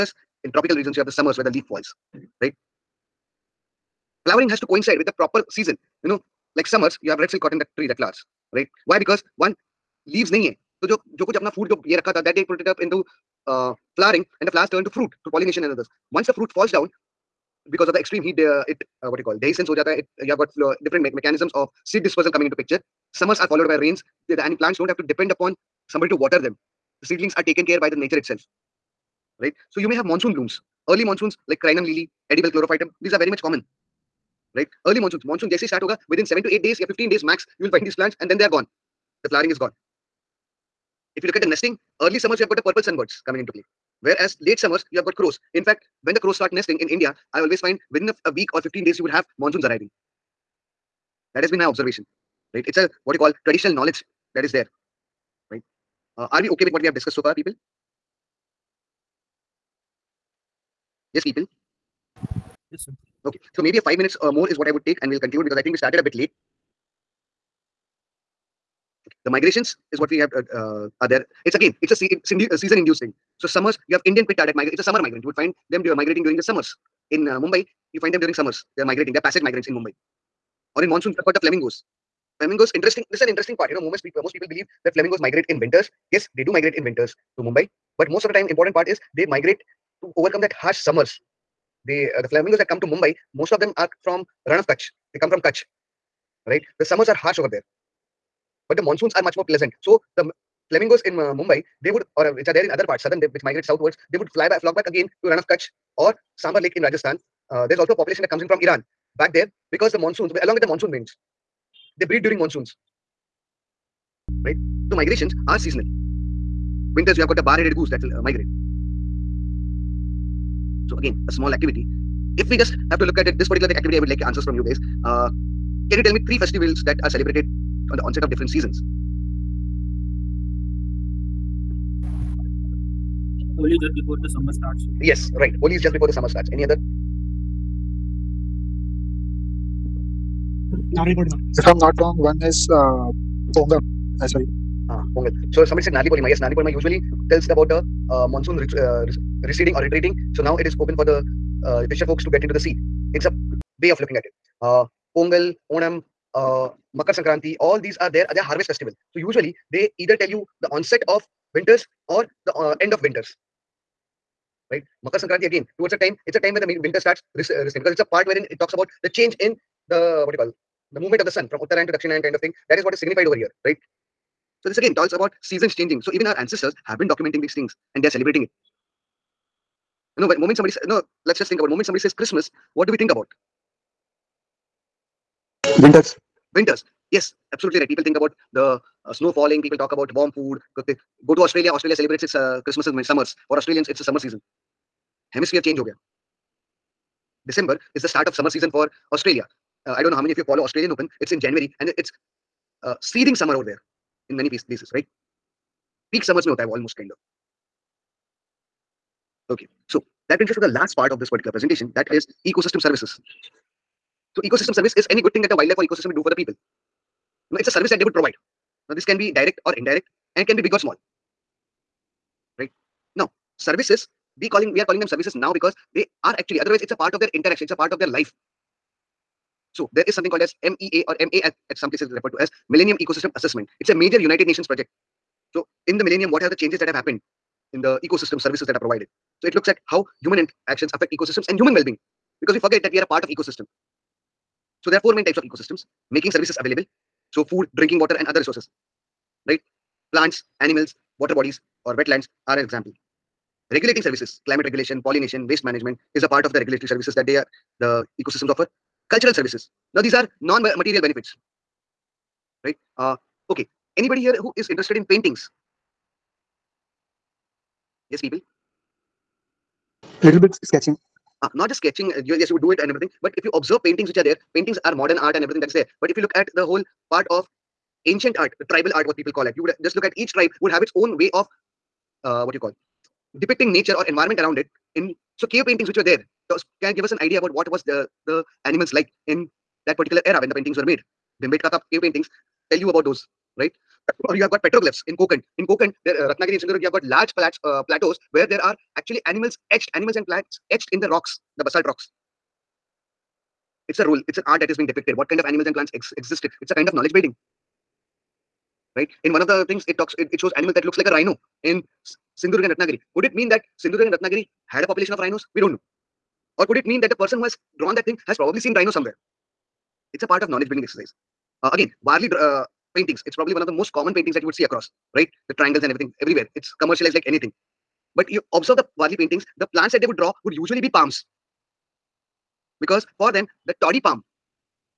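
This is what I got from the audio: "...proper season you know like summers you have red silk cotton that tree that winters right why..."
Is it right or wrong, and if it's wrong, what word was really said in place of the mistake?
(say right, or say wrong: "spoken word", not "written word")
wrong: "flowers", not "winters".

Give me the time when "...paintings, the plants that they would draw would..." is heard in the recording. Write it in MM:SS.
05:29.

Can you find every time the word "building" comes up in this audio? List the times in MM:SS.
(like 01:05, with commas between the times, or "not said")
05:07, 05:20.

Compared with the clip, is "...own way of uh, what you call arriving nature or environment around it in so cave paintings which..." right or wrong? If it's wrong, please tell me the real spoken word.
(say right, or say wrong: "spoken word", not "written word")
wrong: "depicting", not "arriving".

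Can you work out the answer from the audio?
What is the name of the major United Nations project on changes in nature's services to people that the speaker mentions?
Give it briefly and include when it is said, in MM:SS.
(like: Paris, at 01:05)
Millennium Ecosystem Assessment, at 03:52.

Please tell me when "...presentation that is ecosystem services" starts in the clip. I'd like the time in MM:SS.
03:31.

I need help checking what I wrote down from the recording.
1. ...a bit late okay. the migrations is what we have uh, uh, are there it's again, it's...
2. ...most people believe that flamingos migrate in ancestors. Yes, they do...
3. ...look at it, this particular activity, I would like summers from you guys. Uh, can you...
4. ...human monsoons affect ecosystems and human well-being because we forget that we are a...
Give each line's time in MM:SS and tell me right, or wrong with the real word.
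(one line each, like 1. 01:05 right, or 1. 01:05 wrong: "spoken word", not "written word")
1. 01:05 right
2. 01:24 wrong: "winters", not "ancestors"
3. 02:03 wrong: "answers", not "summers"
4. 04:00 wrong: "actions", not "monsoons".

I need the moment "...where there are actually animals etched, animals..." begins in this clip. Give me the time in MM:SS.
04:58.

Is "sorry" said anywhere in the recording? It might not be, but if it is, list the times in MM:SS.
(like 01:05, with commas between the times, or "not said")
02:24.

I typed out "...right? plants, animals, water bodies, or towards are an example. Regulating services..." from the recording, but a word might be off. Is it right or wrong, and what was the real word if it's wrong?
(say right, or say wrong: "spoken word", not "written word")
wrong: "wetlands", not "towards".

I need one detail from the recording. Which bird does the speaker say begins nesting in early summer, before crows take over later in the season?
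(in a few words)
Purple sunbirds.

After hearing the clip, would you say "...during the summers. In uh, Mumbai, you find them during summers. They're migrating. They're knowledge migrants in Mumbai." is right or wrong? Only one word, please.
wrong.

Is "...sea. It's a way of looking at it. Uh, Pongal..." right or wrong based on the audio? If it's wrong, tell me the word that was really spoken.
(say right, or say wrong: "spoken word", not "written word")
right.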